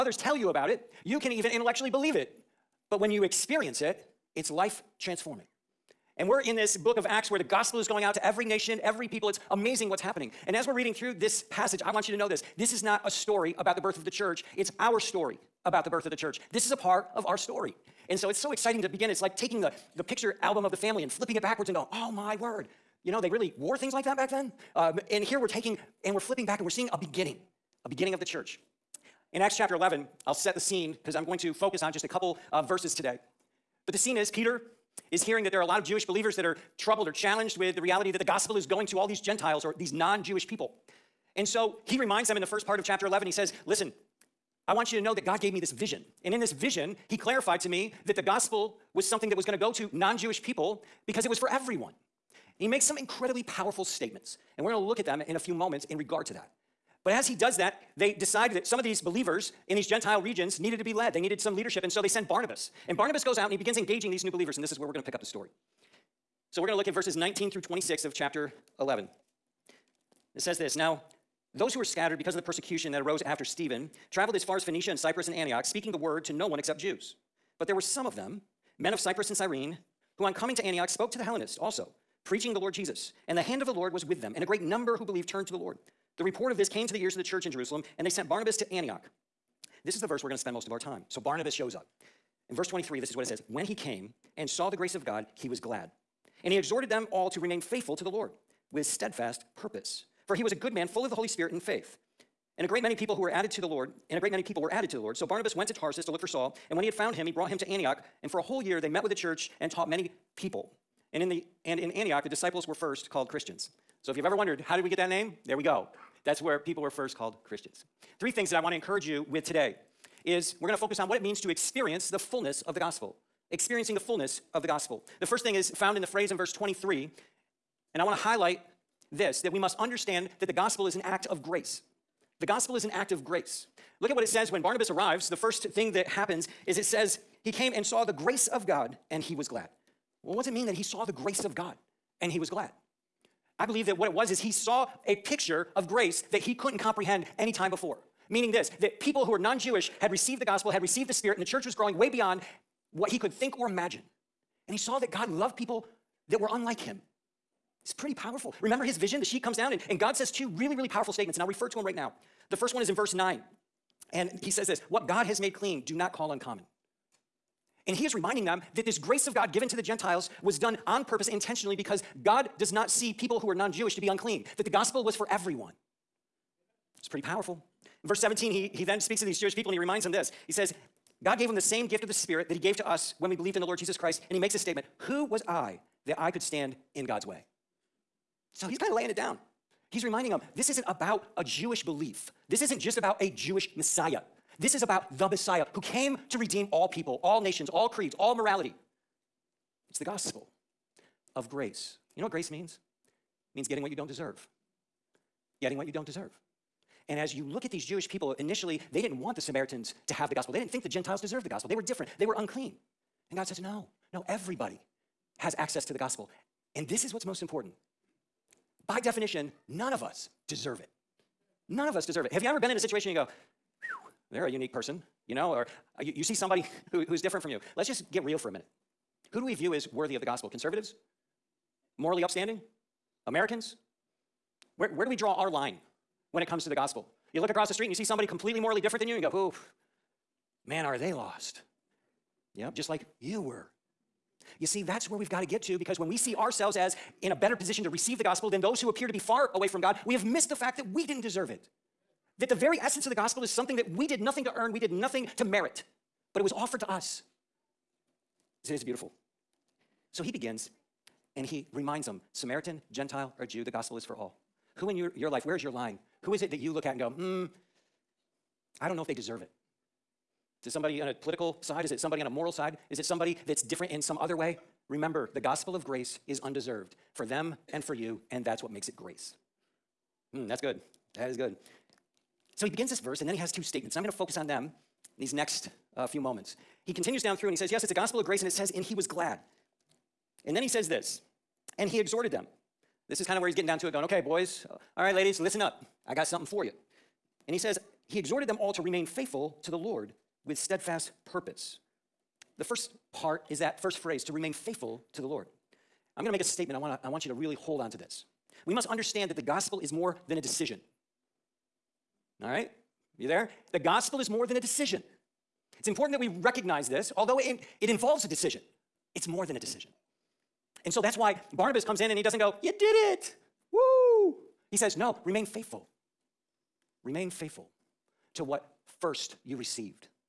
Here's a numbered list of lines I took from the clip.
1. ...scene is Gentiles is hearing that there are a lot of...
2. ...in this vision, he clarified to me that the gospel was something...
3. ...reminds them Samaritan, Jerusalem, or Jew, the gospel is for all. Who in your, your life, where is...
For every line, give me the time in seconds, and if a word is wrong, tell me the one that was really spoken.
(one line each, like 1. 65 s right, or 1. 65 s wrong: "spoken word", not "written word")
1. 33 s wrong: "Peter", not "Gentiles"
2. 46 s right
3. 261 s wrong: "Gentile", not "Jerusalem".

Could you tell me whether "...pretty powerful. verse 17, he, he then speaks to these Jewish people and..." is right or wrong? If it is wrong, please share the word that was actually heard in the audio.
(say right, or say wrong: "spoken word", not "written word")
right.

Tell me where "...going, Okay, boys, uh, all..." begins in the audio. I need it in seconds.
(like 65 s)
293 s.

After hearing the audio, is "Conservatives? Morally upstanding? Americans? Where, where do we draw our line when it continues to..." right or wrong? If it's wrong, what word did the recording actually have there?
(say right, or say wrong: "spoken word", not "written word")
wrong: "comes", not "continues".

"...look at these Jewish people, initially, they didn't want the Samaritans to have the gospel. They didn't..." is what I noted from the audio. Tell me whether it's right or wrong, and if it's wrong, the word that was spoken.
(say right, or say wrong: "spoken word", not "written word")
right.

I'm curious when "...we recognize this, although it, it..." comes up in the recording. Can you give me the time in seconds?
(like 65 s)
316 s.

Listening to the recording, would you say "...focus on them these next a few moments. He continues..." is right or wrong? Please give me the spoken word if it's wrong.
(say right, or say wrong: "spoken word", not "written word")
right.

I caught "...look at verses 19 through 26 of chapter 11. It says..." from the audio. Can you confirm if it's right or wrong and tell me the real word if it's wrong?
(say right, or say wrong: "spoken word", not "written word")
right.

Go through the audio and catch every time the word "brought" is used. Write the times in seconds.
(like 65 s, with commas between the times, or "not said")
107 s.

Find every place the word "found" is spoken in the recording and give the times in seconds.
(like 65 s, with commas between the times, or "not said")
106 s, 125 s.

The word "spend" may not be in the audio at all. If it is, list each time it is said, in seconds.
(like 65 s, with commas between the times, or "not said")
90 s.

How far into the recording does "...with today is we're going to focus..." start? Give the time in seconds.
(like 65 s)
119 s.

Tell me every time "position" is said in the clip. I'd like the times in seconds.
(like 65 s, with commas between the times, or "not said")
247 s.